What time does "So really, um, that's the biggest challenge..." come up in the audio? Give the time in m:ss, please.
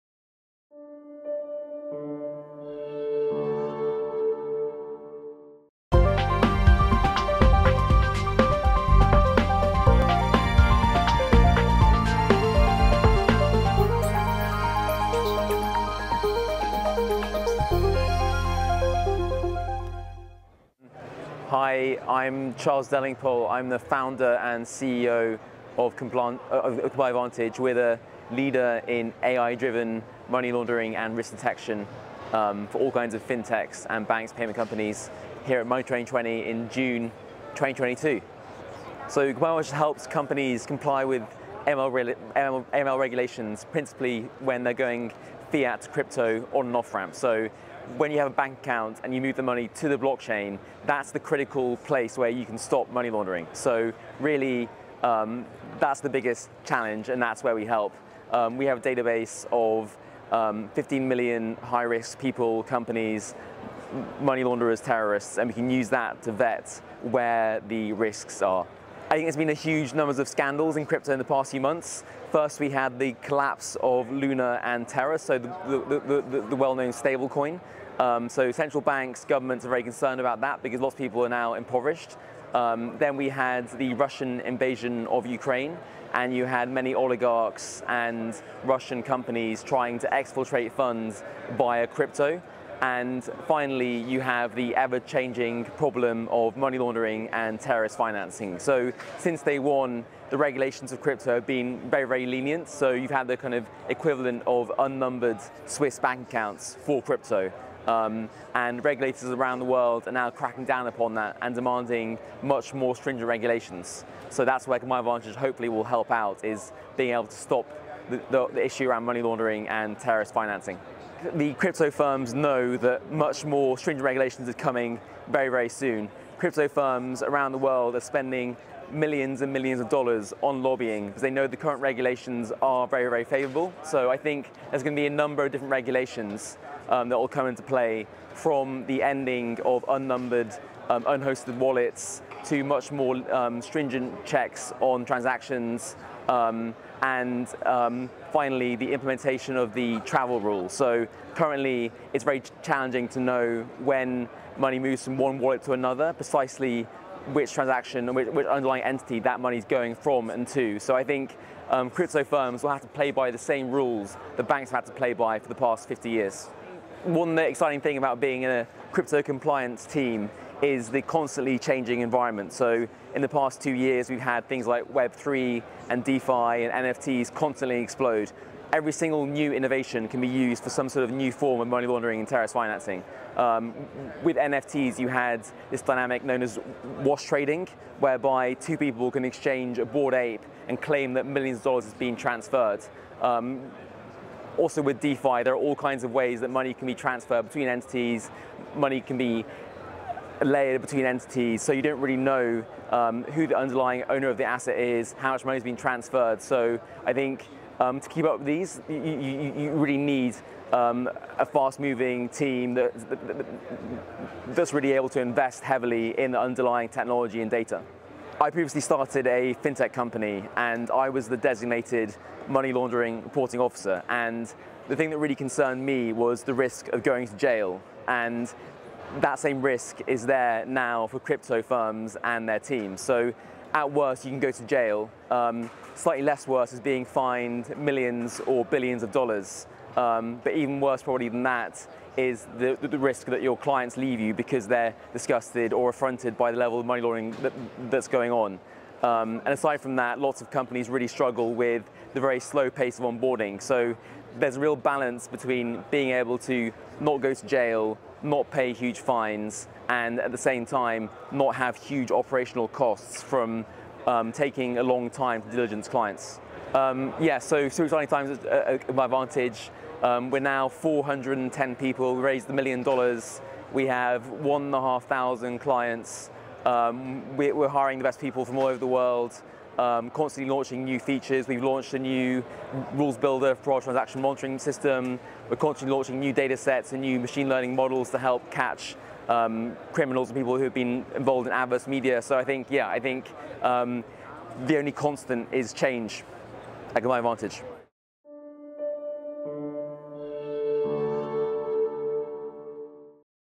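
0:53.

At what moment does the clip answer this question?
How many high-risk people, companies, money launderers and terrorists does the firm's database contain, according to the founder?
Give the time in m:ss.
1:00.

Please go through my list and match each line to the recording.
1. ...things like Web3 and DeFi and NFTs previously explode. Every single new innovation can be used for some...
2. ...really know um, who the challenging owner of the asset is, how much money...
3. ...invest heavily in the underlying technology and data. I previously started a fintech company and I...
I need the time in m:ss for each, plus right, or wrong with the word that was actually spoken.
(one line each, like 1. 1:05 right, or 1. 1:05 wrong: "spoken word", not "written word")
1. 2:54 wrong: "constantly", not "previously"
2. 3:22 wrong: "underlying", not "challenging"
3. 3:35 right.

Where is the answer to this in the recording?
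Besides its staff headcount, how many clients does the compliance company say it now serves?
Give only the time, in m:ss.
4:34.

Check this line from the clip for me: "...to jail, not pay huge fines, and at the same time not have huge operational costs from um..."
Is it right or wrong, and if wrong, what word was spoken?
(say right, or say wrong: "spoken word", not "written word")
right.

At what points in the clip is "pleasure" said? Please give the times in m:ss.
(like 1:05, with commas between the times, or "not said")
not said.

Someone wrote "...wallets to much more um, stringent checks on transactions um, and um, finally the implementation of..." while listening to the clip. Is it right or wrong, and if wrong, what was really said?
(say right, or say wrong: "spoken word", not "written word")
right.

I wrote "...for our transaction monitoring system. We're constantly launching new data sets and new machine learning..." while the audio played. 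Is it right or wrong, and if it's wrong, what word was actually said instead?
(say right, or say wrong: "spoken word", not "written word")
right.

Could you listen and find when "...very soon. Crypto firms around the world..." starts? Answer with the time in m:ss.
2:05.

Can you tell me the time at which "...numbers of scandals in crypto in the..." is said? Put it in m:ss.
1:09.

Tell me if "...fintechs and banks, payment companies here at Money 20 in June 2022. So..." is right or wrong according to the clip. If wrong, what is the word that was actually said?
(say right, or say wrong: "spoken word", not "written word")
right.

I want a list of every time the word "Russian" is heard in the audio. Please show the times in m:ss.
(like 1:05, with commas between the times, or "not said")
1:23, 1:28.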